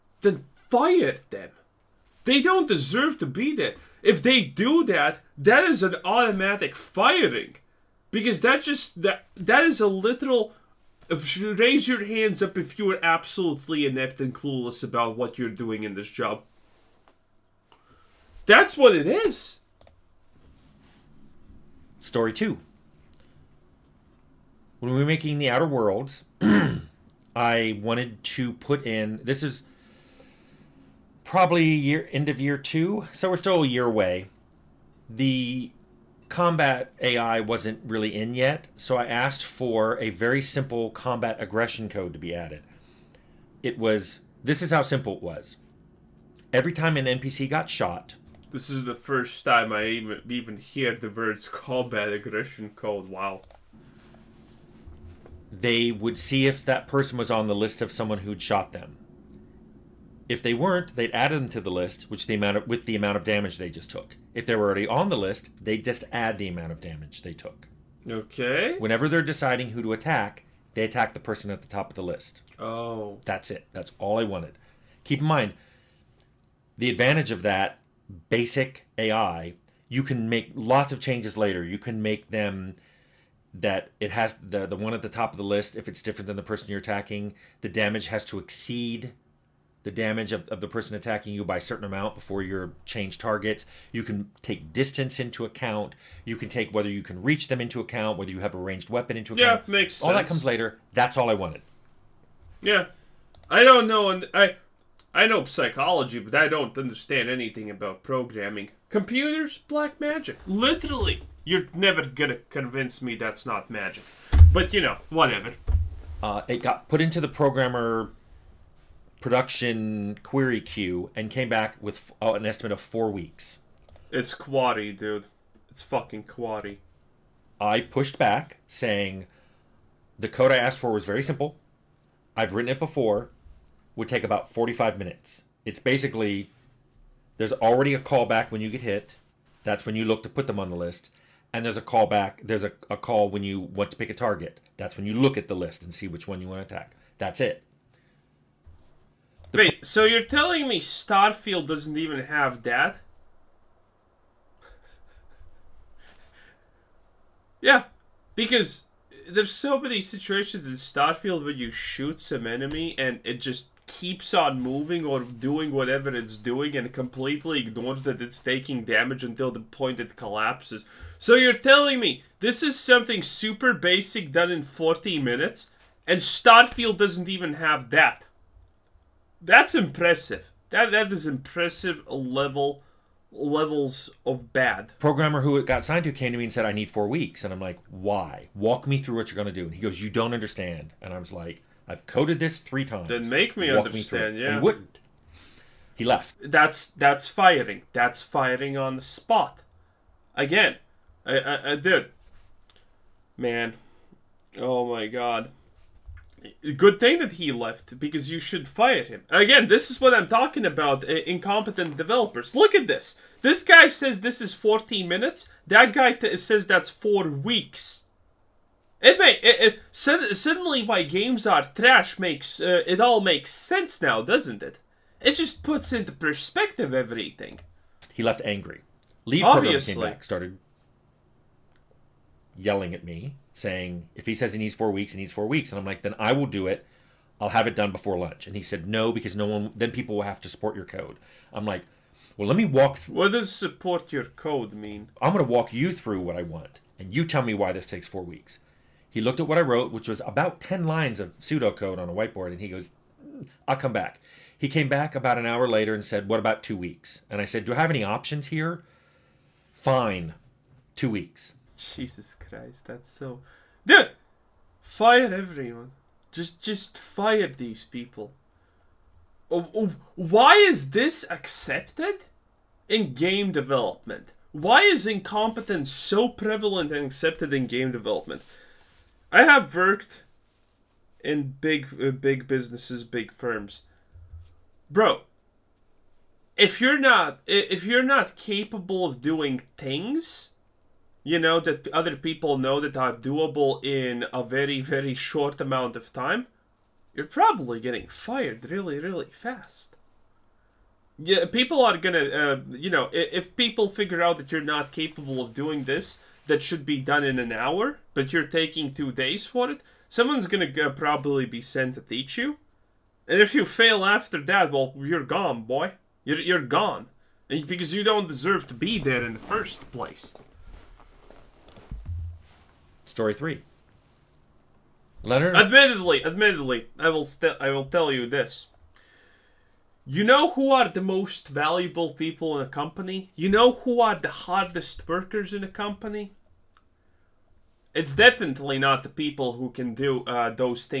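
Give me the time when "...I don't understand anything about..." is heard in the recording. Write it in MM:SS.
01:46.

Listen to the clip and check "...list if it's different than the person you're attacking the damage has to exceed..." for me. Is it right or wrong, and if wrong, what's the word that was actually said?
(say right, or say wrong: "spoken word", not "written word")
right.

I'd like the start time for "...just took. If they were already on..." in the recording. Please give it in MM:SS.
01:03.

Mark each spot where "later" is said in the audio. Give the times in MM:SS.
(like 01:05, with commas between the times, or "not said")
01:21, 01:40, 04:15.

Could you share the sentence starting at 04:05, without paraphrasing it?
I'm going to walk you through what I want.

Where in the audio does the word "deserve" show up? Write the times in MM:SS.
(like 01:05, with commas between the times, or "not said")
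00:02, 05:18.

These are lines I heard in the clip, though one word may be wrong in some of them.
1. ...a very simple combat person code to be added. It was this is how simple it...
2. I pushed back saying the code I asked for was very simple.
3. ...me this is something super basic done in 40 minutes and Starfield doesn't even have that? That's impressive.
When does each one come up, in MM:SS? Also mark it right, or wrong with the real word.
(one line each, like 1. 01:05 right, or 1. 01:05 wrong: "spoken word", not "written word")
1. 00:39 wrong: "aggression", not "person"
2. 02:07 right
3. 02:51 right.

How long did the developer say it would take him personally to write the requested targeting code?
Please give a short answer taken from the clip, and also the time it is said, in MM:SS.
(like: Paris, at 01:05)
45 minutes, at 02:14.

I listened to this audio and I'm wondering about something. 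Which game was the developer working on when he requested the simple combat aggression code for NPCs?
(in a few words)
The Outer Worlds.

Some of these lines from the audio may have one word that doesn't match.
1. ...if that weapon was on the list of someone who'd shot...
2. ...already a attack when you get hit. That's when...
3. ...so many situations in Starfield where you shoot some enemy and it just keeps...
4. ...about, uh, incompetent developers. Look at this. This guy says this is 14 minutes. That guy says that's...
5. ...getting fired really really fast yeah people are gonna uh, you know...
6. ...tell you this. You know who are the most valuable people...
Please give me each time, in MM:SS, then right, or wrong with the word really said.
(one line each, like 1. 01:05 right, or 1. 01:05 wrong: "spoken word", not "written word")
1. 00:56 wrong: "person", not "weapon"
2. 02:17 wrong: "callback", not "attack"
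3. 02:39 right
4. 03:30 right
5. 04:57 right
6. 05:27 right.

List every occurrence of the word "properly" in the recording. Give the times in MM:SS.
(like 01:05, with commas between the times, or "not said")
not said.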